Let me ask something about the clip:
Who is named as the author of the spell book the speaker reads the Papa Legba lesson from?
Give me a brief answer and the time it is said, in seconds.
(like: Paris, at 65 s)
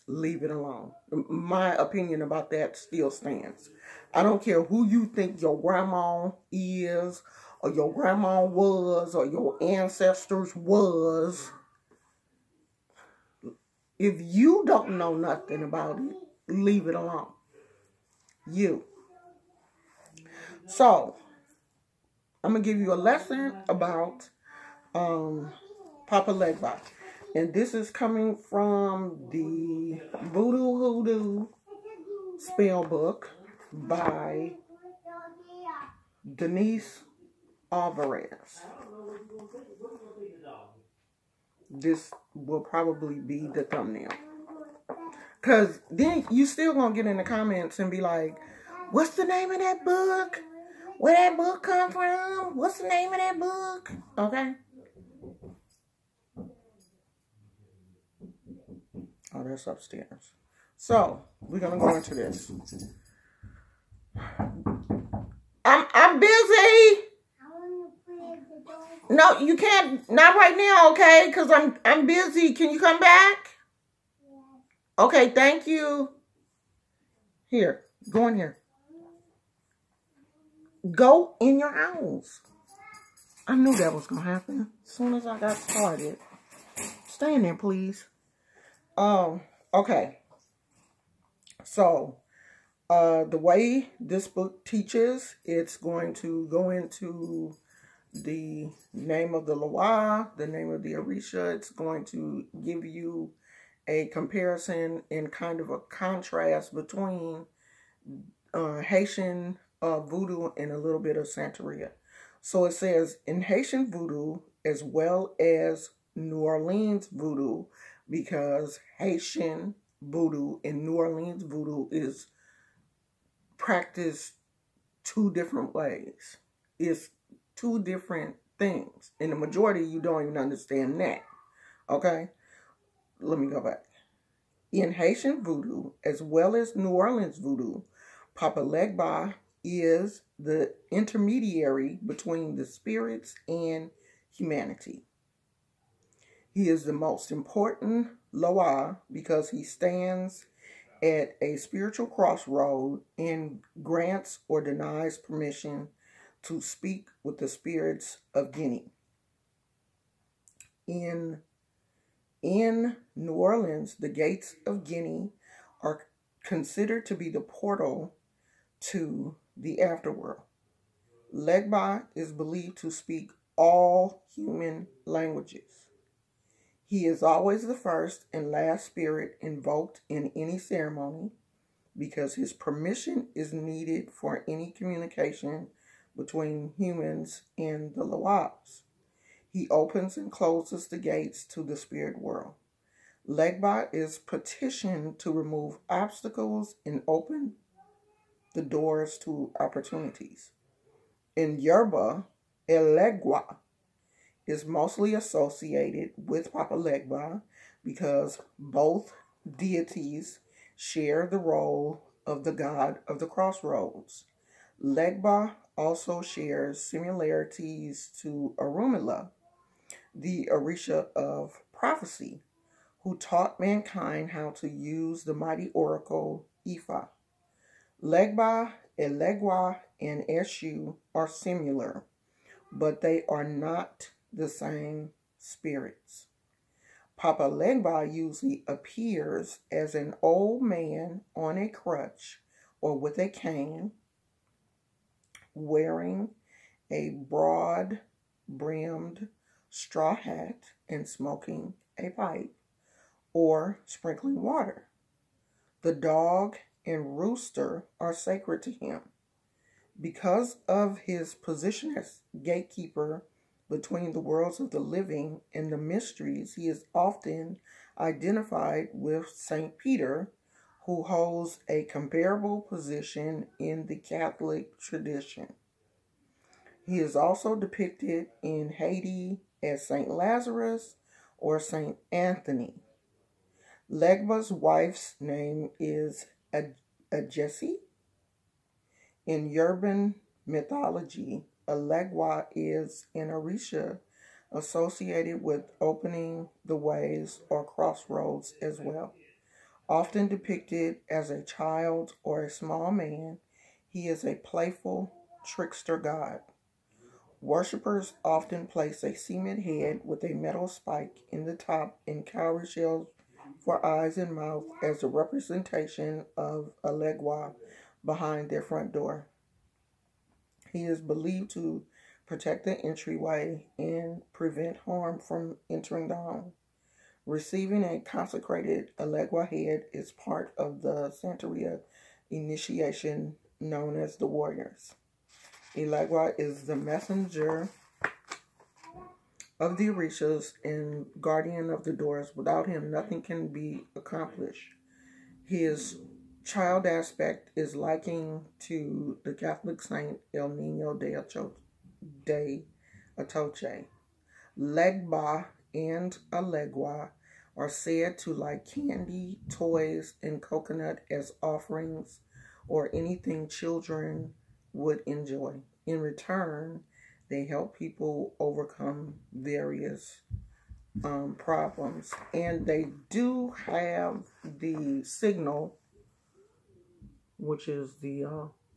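Denise Alvarez, at 36 s.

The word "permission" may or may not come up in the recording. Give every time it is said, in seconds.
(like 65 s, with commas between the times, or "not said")
155 s, 182 s.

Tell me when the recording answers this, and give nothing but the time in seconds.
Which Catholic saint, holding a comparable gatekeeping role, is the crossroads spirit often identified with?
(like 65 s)
269 s.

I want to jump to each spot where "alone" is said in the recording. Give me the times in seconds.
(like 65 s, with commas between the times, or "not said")
0 s, 16 s.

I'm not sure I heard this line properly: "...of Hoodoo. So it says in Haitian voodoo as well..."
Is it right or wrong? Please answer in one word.
wrong.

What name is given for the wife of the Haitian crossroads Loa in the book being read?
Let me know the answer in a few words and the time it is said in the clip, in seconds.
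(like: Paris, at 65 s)
Ajesi, at 287 s.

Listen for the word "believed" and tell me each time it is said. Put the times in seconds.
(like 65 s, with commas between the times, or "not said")
172 s, 321 s.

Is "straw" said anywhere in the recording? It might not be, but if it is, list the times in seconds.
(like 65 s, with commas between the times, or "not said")
249 s.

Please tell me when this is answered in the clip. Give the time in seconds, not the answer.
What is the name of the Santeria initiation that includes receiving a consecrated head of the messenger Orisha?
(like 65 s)
334 s.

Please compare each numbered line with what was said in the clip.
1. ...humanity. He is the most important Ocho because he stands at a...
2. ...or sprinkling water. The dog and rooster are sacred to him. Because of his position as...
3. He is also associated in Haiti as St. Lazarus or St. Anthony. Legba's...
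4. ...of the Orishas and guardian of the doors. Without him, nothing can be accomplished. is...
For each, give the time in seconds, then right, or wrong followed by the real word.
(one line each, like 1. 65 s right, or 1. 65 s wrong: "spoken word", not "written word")
1. 144 s wrong: "Loa", not "Ocho"
2. 253 s right
3. 276 s wrong: "depicted", not "associated"
4. 339 s right.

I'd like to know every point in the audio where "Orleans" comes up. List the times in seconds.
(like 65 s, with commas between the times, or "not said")
116 s, 120 s, 136 s, 163 s.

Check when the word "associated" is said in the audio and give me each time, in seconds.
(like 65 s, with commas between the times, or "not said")
205 s, 294 s.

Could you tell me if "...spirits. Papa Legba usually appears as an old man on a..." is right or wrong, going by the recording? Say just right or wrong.
right.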